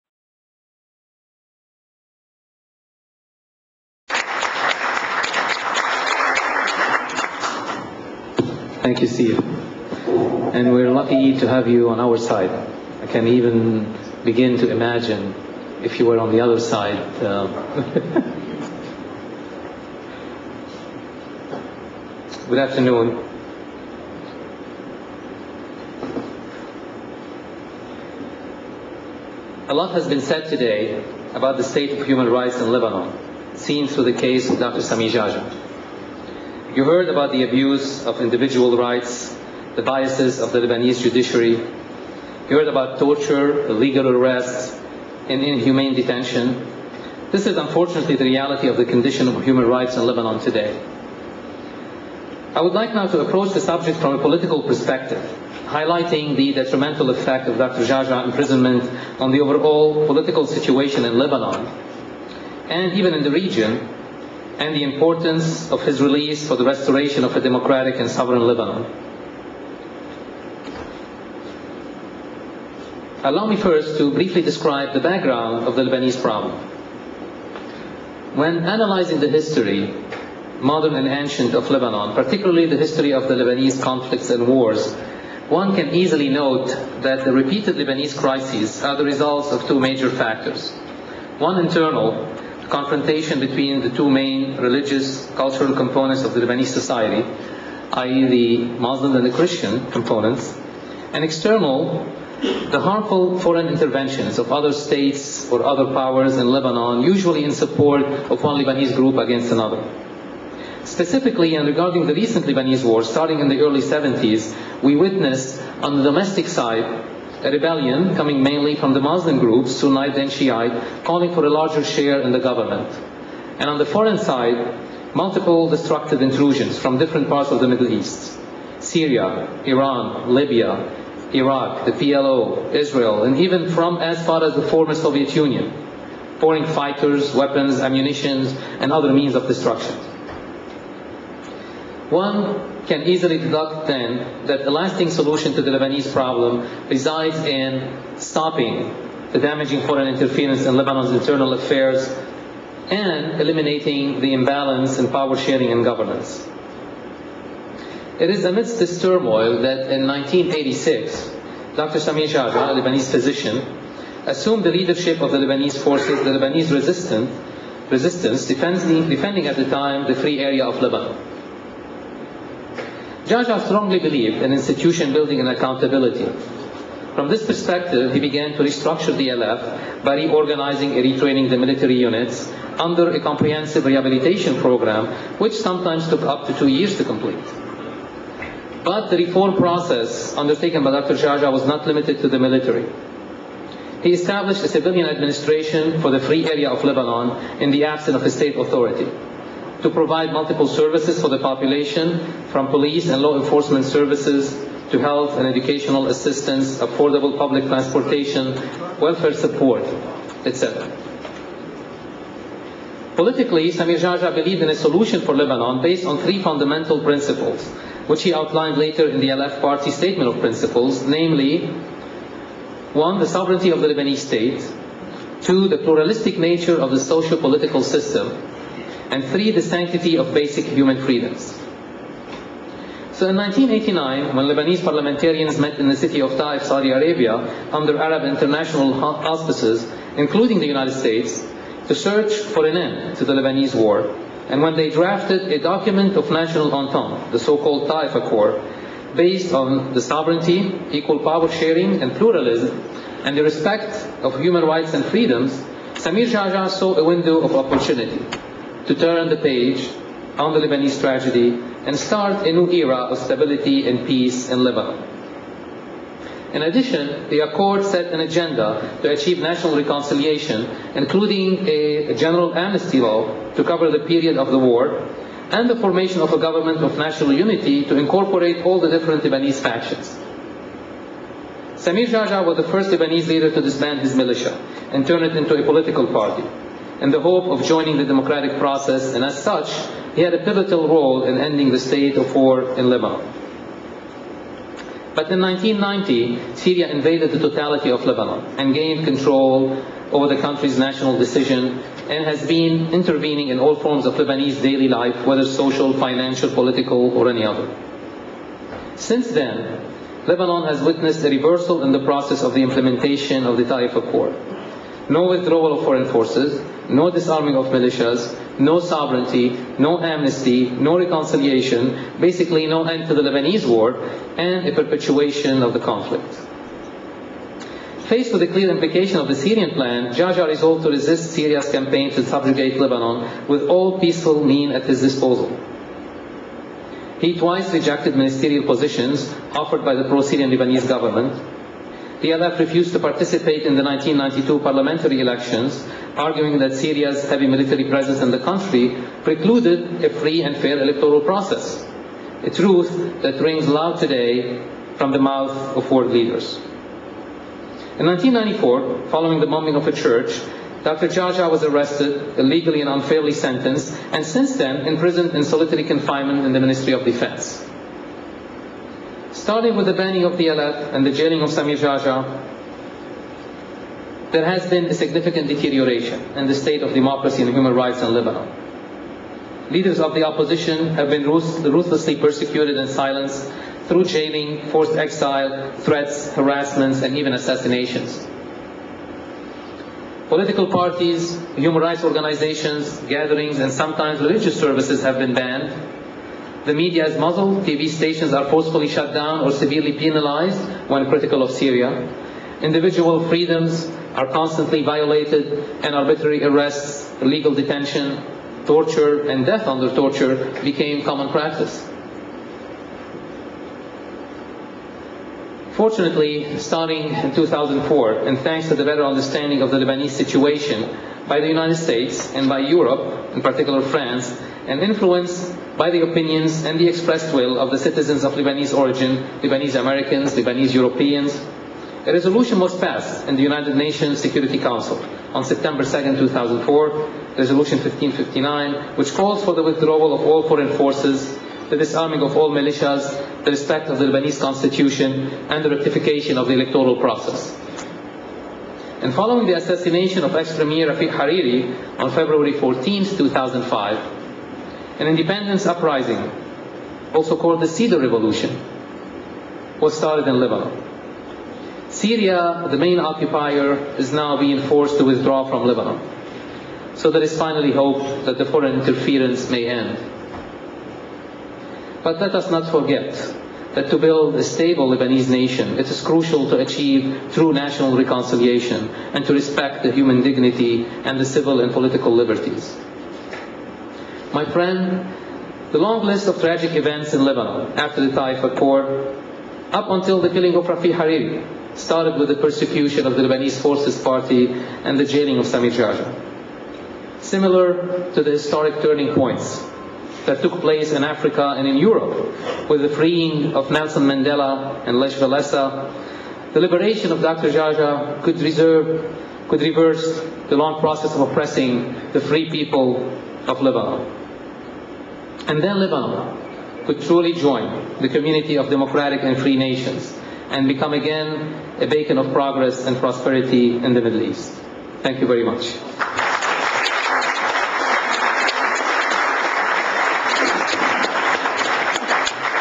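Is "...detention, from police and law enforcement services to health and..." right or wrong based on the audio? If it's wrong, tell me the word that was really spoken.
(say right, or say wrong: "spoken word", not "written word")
wrong: "population", not "detention".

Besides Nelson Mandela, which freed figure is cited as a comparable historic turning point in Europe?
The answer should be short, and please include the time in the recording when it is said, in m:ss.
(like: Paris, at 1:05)
Lech Walesa, at 8:24.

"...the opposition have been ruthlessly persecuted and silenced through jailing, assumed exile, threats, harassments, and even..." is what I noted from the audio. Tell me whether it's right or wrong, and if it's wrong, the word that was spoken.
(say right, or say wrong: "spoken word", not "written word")
wrong: "forced", not "assumed".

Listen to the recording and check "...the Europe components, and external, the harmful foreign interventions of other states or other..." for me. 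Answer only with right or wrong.
wrong.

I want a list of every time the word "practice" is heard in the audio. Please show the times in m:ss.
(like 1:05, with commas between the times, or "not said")
6:51.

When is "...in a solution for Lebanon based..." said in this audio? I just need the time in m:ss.
3:34.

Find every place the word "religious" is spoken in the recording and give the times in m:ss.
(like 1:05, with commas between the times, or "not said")
1:34, 6:34.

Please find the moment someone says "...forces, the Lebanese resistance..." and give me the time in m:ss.
2:45.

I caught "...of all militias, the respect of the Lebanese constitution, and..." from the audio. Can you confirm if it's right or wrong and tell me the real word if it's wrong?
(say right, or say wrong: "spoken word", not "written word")
right.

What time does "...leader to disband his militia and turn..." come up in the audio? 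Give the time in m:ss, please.
4:43.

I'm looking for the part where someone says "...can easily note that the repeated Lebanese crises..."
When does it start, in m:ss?
1:25.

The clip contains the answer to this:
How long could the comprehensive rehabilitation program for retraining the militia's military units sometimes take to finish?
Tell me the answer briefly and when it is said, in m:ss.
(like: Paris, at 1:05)
up to two years, at 3:06.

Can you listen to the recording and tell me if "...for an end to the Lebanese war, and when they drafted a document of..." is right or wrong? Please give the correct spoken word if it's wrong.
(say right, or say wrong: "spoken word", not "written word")
right.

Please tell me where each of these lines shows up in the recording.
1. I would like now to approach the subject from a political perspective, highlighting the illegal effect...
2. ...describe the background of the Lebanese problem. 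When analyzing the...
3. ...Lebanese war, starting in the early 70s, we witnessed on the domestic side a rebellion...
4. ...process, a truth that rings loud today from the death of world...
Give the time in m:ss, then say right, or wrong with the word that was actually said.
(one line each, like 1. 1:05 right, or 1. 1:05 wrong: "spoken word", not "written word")
1. 0:52 wrong: "detrimental", not "illegal"
2. 1:14 right
3. 1:52 right
4. 5:51 wrong: "mouth", not "death".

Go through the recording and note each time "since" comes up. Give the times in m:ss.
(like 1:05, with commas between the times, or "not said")
5:08, 6:04.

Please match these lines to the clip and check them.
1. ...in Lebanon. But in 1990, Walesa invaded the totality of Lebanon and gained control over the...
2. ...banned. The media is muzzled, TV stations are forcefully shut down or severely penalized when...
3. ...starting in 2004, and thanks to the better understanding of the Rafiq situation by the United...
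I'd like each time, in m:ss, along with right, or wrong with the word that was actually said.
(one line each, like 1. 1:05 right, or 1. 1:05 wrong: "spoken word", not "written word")
1. 4:52 wrong: "Syria", not "Walesa"
2. 6:35 right
3. 6:56 wrong: "Lebanese", not "Rafiq".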